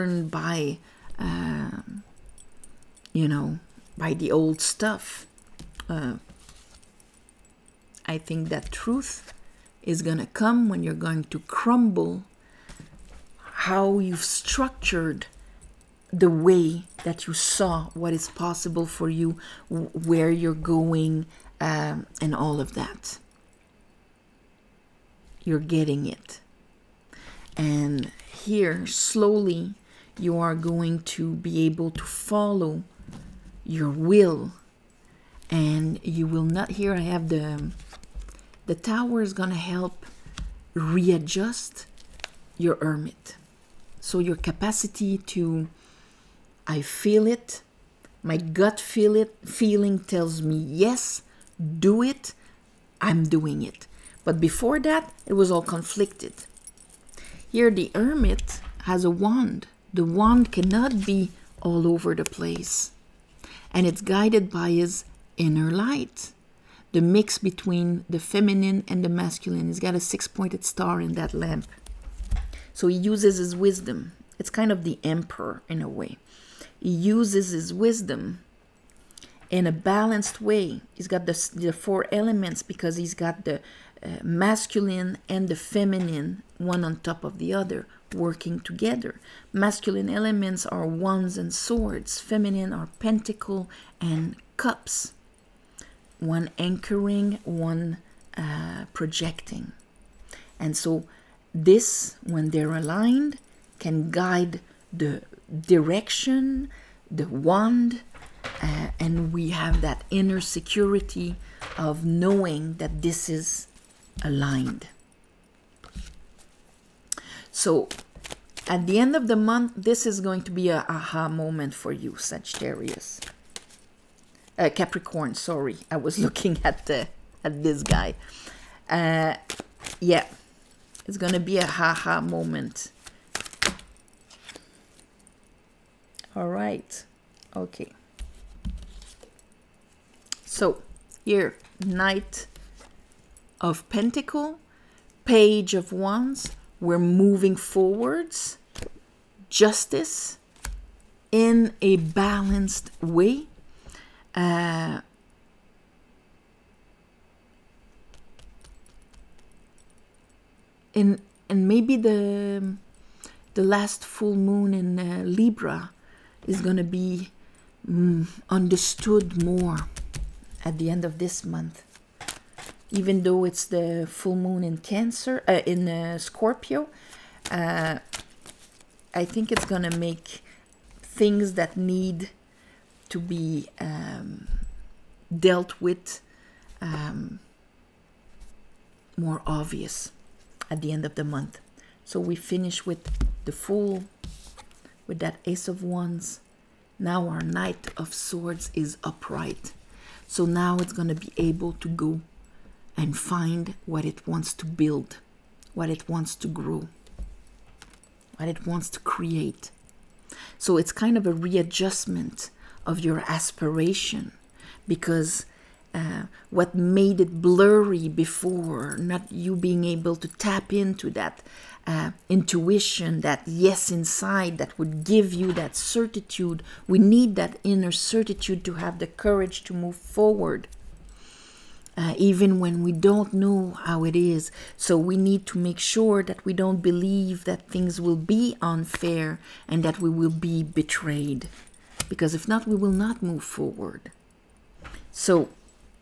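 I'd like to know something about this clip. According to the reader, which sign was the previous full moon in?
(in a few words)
Libra.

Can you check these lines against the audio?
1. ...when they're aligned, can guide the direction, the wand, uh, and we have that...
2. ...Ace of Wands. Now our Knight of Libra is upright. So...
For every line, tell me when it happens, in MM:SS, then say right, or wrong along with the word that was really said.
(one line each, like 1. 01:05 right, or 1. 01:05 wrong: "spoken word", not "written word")
1. 01:42 right
2. 03:15 wrong: "Swords", not "Libra".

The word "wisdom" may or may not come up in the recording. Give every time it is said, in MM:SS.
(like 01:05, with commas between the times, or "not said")
01:13, 01:17.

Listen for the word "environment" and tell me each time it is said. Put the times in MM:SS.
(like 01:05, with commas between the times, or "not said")
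not said.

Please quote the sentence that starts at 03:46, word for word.
We need that inner certitude to have the courage to move forward, uh, even when we don't know how it is.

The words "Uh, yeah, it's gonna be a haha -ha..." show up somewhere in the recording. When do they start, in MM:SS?
02:08.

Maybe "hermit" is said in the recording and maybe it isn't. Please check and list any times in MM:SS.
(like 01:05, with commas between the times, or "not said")
00:42, 00:57.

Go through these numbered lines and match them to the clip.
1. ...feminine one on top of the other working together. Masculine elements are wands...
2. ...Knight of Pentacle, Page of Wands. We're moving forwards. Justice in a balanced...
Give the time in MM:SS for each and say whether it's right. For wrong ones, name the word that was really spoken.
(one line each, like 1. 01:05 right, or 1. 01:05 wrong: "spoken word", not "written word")
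1. 01:25 right
2. 02:21 right.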